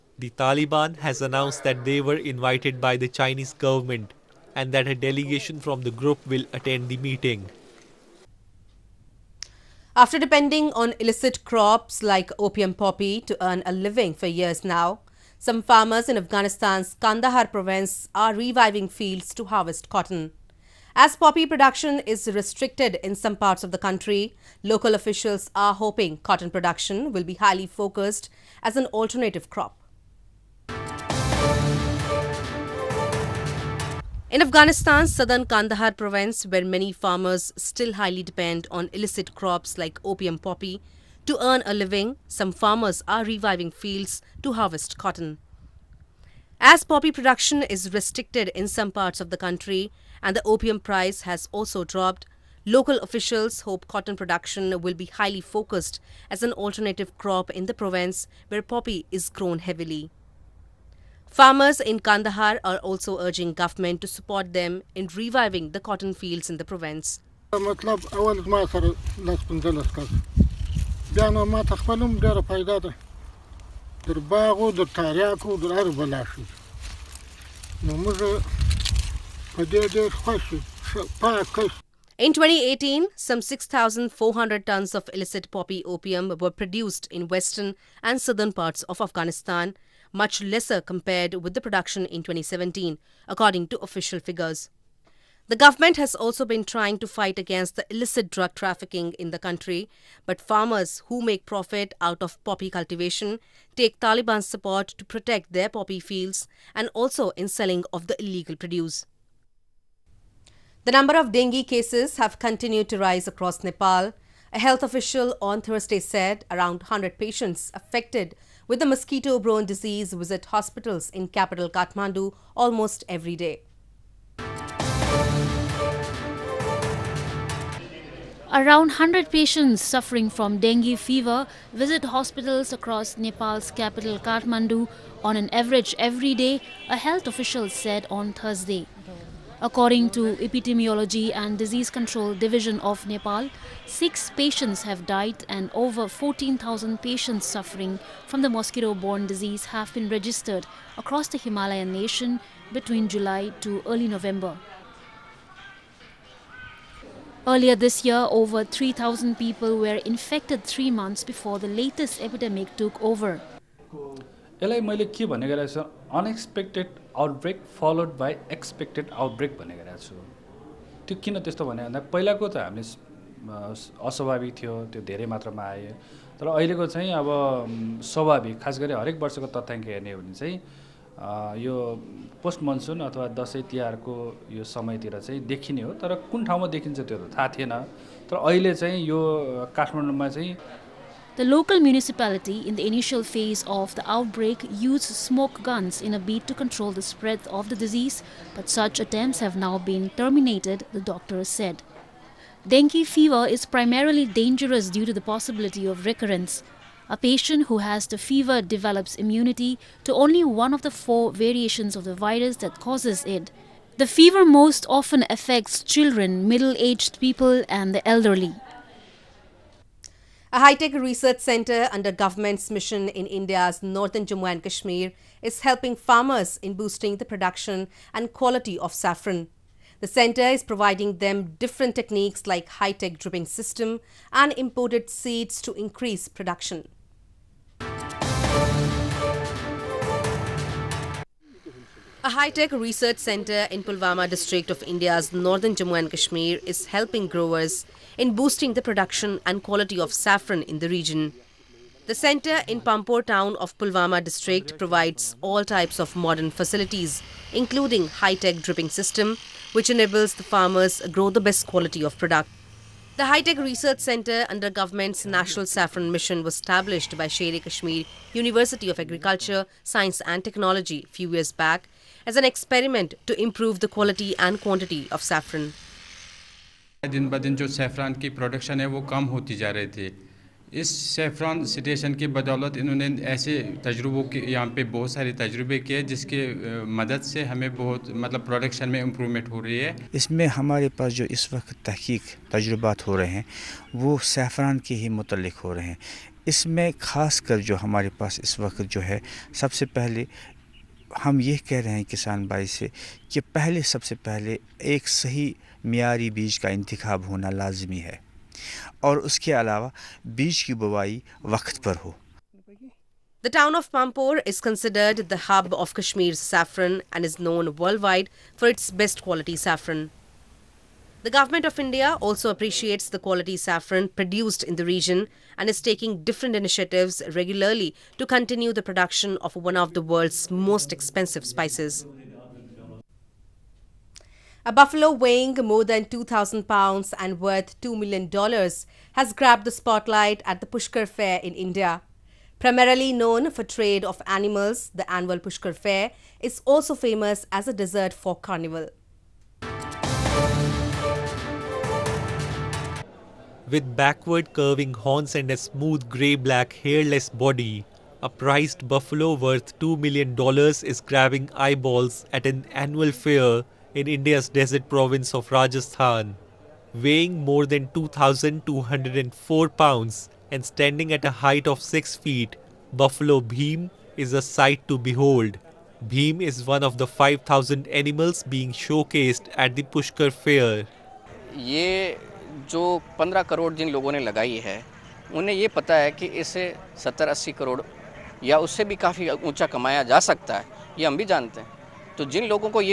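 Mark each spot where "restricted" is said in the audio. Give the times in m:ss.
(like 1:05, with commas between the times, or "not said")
0:22, 0:47.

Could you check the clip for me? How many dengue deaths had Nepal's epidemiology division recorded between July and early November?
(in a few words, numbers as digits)
6.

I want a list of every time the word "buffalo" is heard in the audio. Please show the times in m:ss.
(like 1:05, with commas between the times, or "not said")
5:34, 5:58, 6:12.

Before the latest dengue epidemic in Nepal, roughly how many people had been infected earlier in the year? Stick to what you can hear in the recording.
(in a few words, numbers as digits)
3,000.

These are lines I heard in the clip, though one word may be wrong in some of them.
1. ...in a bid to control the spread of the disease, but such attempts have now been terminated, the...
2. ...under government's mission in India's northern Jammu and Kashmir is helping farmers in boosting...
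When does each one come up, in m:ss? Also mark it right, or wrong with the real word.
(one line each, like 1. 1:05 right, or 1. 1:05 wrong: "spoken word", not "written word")
1. 3:16 right
2. 3:41 right.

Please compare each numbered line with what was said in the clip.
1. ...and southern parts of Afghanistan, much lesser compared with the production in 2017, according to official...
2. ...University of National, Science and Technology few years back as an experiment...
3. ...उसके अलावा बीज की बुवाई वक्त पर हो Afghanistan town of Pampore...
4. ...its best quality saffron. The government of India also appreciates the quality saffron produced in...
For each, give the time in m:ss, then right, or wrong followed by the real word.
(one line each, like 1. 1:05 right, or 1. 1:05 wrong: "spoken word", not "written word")
1. 1:28 right
2. 4:28 wrong: "Agriculture", not "National"
3. 5:09 wrong: "The", not "Afghanistan"
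4. 5:18 right.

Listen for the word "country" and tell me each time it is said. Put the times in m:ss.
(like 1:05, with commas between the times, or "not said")
0:23, 0:49, 1:39.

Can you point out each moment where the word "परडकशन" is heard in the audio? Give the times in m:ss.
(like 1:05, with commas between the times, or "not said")
4:38, 4:48.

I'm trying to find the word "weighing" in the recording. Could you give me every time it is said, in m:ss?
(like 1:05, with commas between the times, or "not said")
5:35, 6:06.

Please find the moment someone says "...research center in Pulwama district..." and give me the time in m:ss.
4:02.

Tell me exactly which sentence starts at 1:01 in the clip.
Farmers in Kandahar are also urging government to support them in reviving the cotton fields in the province.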